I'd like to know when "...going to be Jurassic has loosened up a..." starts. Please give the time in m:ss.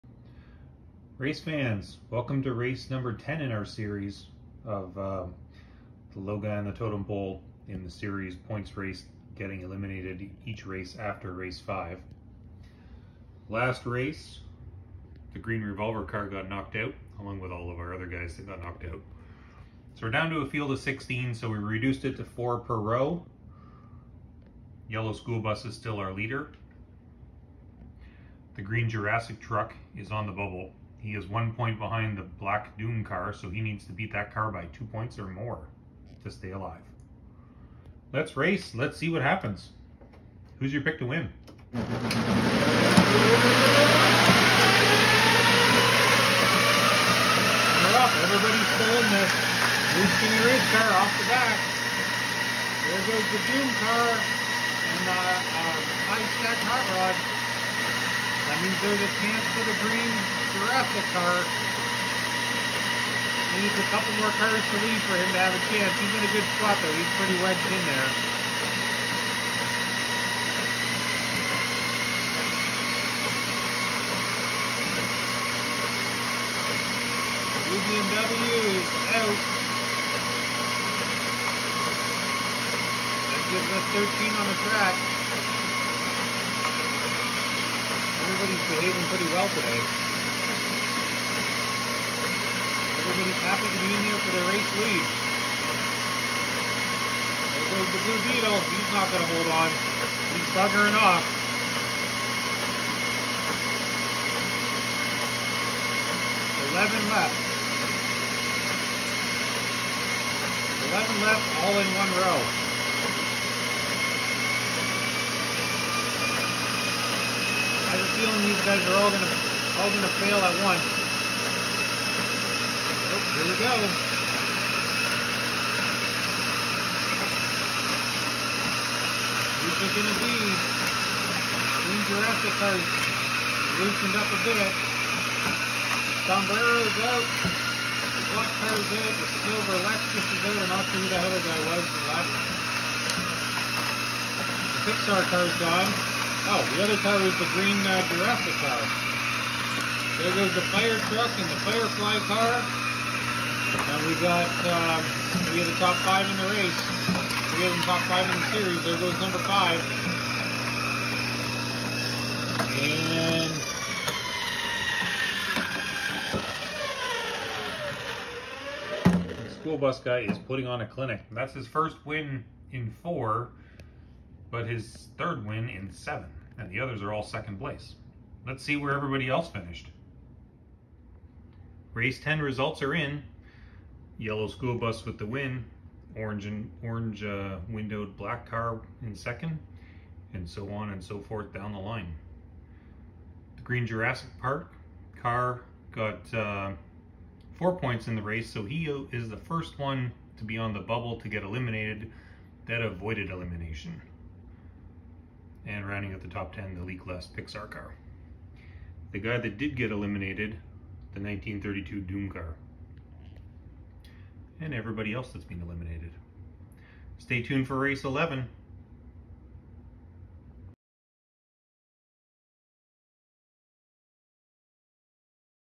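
2:09.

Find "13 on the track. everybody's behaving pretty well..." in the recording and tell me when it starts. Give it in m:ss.
1:23.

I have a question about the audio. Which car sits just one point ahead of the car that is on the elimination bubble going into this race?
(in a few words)
Black Doom car.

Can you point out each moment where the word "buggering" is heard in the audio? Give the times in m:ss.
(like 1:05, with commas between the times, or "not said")
1:40.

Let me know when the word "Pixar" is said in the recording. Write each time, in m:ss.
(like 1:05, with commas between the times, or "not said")
2:24, 3:27.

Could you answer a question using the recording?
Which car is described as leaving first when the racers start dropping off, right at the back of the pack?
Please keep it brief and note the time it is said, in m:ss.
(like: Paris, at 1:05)
Blue Skinny Race car, at 0:49.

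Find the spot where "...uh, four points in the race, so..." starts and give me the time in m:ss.
3:16.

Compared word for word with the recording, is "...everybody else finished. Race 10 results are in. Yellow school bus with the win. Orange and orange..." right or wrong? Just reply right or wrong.
right.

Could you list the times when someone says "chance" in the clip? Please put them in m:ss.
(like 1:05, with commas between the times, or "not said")
0:59, 1:05.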